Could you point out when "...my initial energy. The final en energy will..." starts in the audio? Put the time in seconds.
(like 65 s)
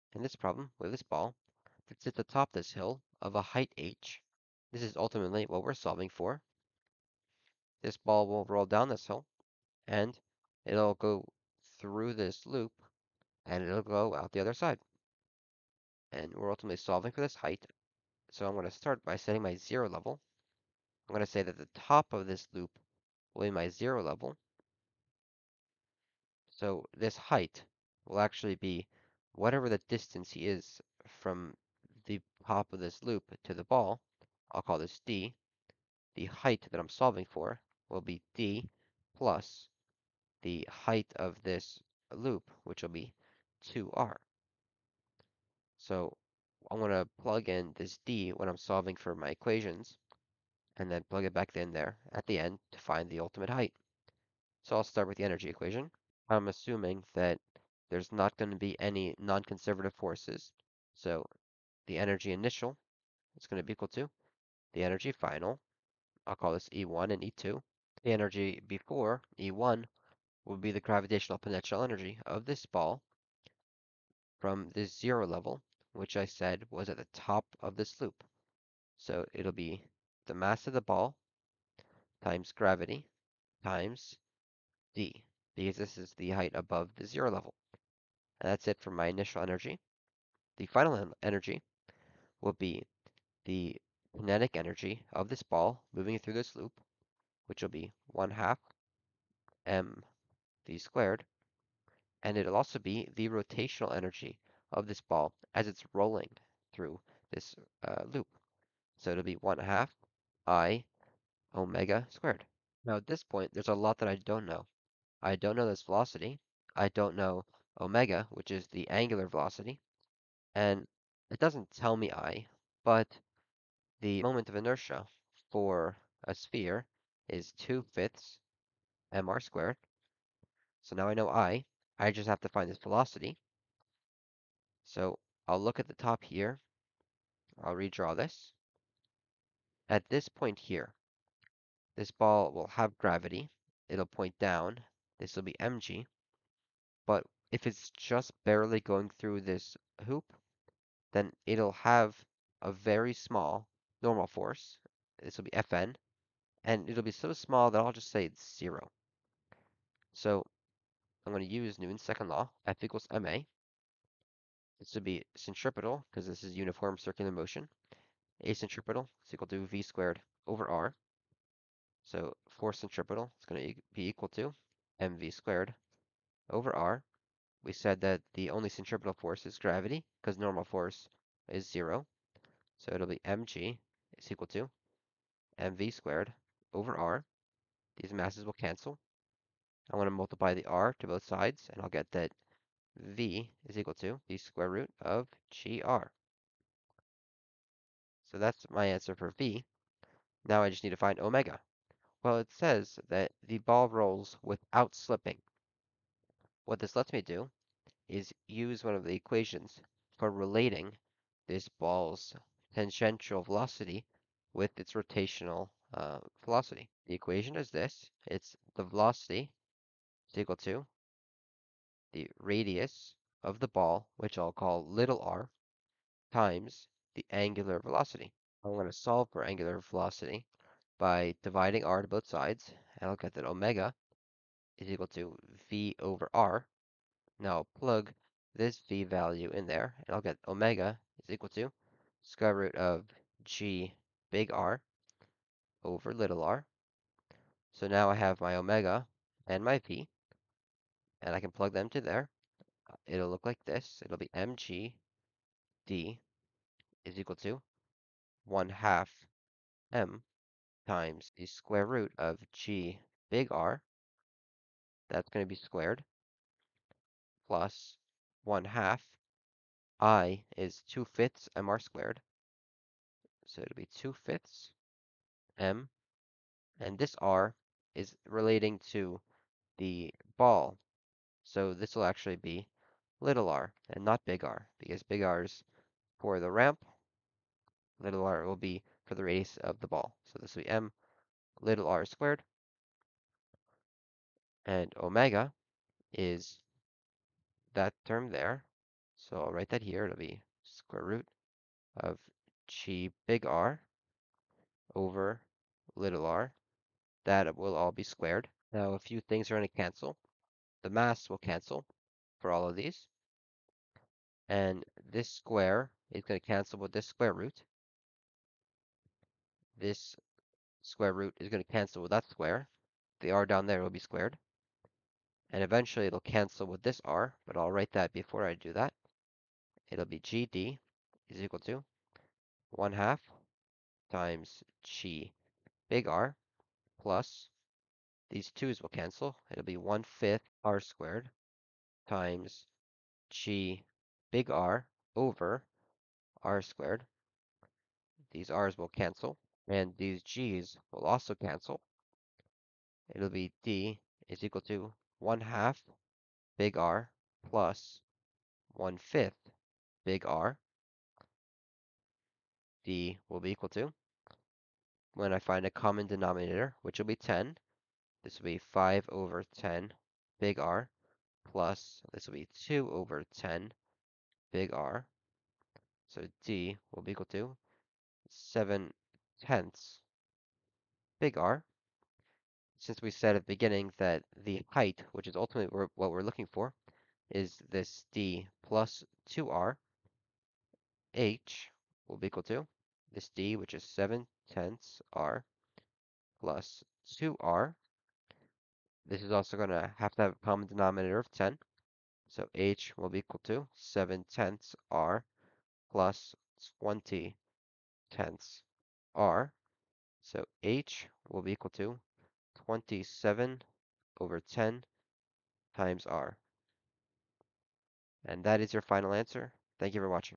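88 s.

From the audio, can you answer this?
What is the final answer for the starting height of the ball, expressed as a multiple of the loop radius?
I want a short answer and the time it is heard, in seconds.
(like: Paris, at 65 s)
27/10 r, at 412 s.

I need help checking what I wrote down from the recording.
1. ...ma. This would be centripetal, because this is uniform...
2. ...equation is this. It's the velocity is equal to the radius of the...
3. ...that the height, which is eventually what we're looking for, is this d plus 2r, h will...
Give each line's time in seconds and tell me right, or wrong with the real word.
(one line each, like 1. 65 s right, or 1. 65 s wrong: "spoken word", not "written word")
1. 163 s right
2. 217 s right
3. 383 s wrong: "ultimately", not "eventually".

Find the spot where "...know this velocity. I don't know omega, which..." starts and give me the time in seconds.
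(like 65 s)
115 s.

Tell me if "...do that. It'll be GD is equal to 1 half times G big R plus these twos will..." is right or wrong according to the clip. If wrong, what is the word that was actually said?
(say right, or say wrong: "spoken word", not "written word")
right.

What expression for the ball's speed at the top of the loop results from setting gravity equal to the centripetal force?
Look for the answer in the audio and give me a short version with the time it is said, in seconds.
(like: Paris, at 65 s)
square root of gr, at 194 s.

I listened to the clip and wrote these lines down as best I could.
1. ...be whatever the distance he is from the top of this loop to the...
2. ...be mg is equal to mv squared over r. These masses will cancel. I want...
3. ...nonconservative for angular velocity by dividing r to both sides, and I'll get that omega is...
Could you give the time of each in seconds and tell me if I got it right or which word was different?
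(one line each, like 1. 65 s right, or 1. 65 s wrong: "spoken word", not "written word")
1. 28 s right
2. 183 s right
3. 228 s wrong: "solve", not "nonconservative".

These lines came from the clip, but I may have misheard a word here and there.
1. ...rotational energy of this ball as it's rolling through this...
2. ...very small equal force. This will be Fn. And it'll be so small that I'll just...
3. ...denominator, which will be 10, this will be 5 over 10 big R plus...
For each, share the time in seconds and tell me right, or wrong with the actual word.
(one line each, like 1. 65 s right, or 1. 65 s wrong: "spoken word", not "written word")
1. 103 s right
2. 152 s wrong: "normal", not "equal"
3. 366 s right.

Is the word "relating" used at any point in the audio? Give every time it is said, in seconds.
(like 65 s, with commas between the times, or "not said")
210 s, 278 s.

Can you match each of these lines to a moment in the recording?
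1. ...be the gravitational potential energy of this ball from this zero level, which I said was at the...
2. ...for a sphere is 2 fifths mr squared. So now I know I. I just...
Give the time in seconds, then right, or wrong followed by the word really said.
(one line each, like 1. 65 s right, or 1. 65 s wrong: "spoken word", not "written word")
1. 70 s right
2. 125 s right.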